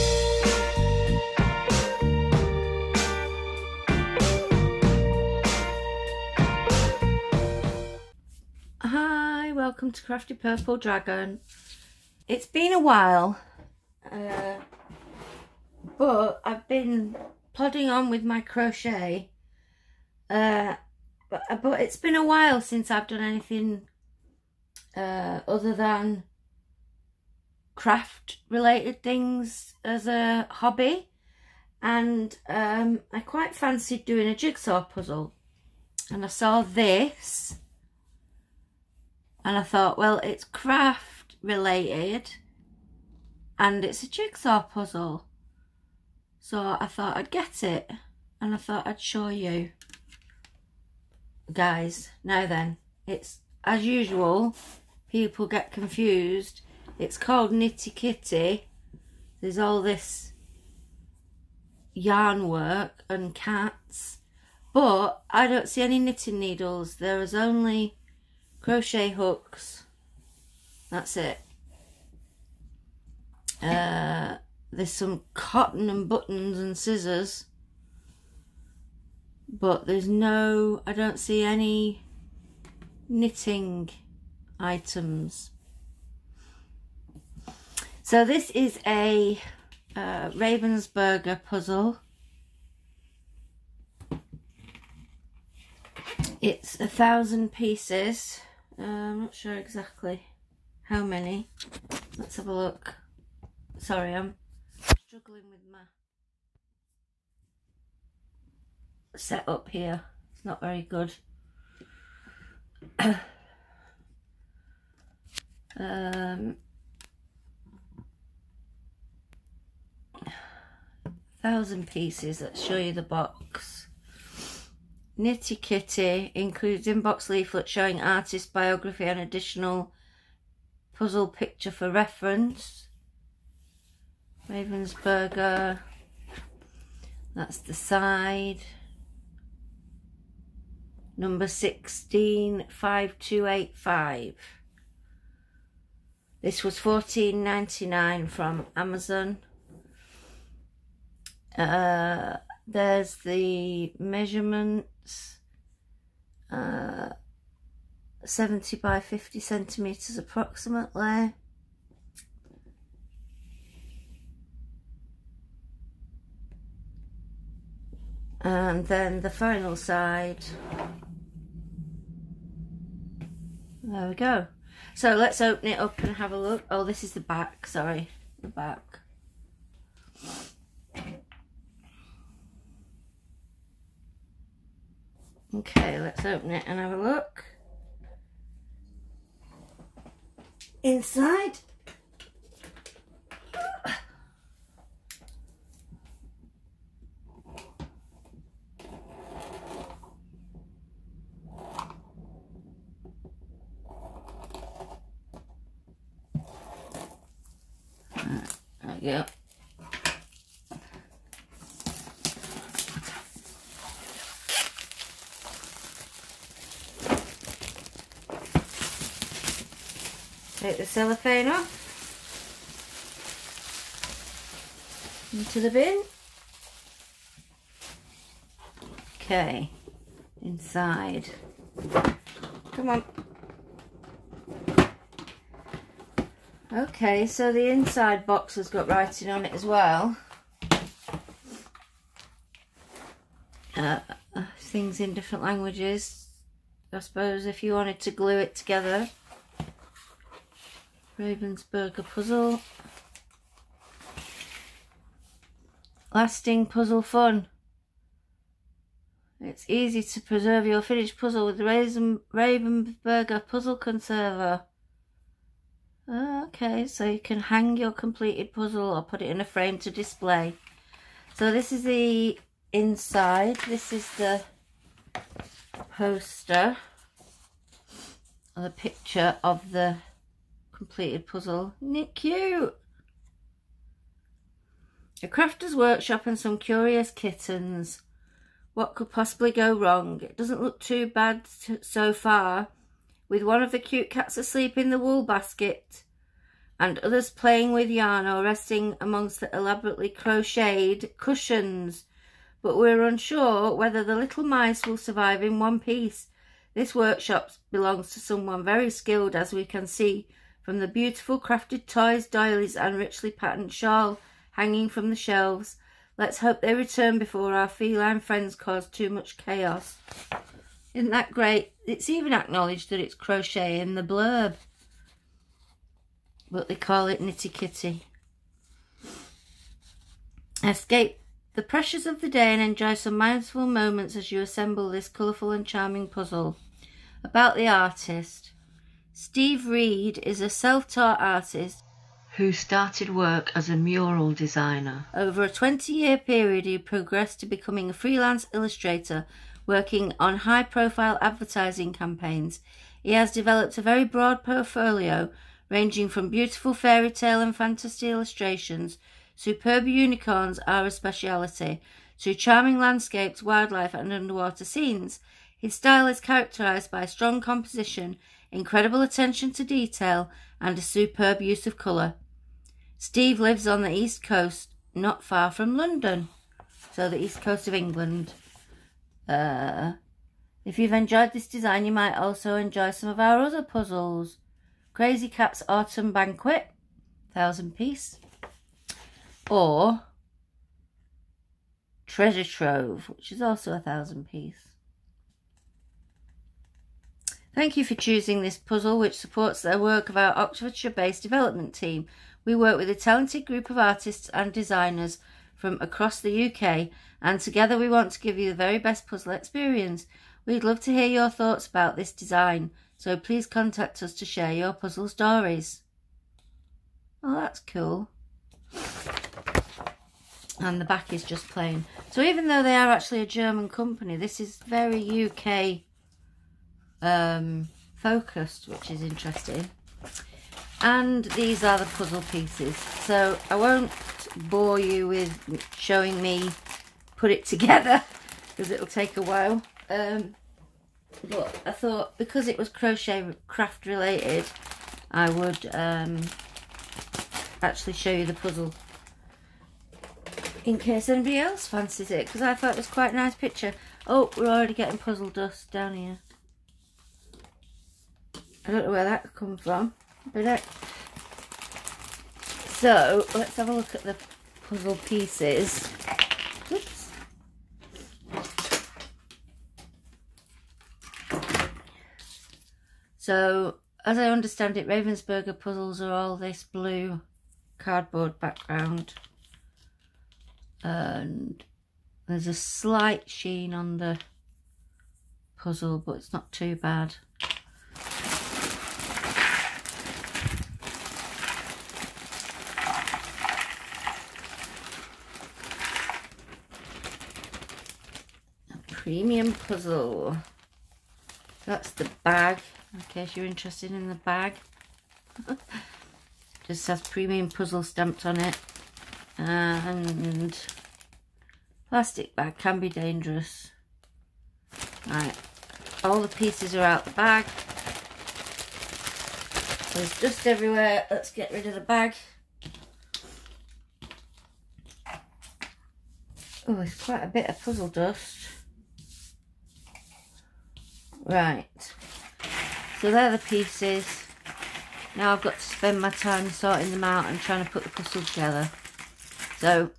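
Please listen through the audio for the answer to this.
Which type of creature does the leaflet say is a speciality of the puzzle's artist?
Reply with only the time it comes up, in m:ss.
5:59.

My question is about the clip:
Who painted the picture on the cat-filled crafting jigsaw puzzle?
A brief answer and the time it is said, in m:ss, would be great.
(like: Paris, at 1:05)
Steve Read, at 5:39.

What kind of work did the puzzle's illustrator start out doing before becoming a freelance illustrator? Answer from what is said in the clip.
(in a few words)
mural designer.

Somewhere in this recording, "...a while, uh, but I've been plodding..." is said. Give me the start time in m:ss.
0:12.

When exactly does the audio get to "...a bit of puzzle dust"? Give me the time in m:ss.
8:47.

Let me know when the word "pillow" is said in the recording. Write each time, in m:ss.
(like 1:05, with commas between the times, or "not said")
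not said.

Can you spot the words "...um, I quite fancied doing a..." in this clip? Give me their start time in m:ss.
0:32.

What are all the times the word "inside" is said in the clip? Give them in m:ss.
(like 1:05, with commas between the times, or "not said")
3:10, 3:50, 3:57, 4:32.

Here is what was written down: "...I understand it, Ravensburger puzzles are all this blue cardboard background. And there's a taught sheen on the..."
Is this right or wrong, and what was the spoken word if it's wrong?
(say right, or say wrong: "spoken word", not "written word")
wrong: "slight", not "taught".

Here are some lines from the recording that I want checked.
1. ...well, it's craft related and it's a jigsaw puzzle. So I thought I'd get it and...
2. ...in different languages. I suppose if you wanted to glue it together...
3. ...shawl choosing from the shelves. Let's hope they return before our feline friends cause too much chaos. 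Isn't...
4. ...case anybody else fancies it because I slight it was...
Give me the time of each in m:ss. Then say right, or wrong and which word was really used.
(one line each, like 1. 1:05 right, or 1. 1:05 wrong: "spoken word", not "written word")
1. 0:39 right
2. 4:04 right
3. 5:13 wrong: "hanging", not "choosing"
4. 7:30 wrong: "thought", not "slight".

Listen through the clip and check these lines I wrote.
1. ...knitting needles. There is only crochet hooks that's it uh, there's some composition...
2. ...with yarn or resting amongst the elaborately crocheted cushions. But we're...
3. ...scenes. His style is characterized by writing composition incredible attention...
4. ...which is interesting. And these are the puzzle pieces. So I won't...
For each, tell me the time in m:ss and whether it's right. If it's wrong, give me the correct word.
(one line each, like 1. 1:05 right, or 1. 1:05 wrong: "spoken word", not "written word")
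1. 1:05 wrong: "cotton", not "composition"
2. 4:57 right
3. 6:04 wrong: "strong", not "writing"
4. 7:08 right.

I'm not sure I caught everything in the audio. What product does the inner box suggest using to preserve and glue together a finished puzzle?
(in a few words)
Ravensburger puzzle conserver.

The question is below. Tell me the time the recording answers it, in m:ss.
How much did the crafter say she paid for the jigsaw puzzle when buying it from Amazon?
2:26.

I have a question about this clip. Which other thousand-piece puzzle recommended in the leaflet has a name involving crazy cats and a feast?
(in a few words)
Crazy Cat's Autumn Banquet.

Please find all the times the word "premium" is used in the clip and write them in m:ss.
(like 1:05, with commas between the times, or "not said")
8:19, 8:27.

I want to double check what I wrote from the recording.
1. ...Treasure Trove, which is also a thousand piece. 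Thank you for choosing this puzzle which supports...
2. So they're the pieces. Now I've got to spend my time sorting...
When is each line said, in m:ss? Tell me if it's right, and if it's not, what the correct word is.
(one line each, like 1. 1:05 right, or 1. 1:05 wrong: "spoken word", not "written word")
1. 6:32 right
2. 8:53 right.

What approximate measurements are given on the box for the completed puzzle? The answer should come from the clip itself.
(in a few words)
70 by 50 centimetres.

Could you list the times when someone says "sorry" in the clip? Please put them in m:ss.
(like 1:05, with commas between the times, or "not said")
1:43, 2:57.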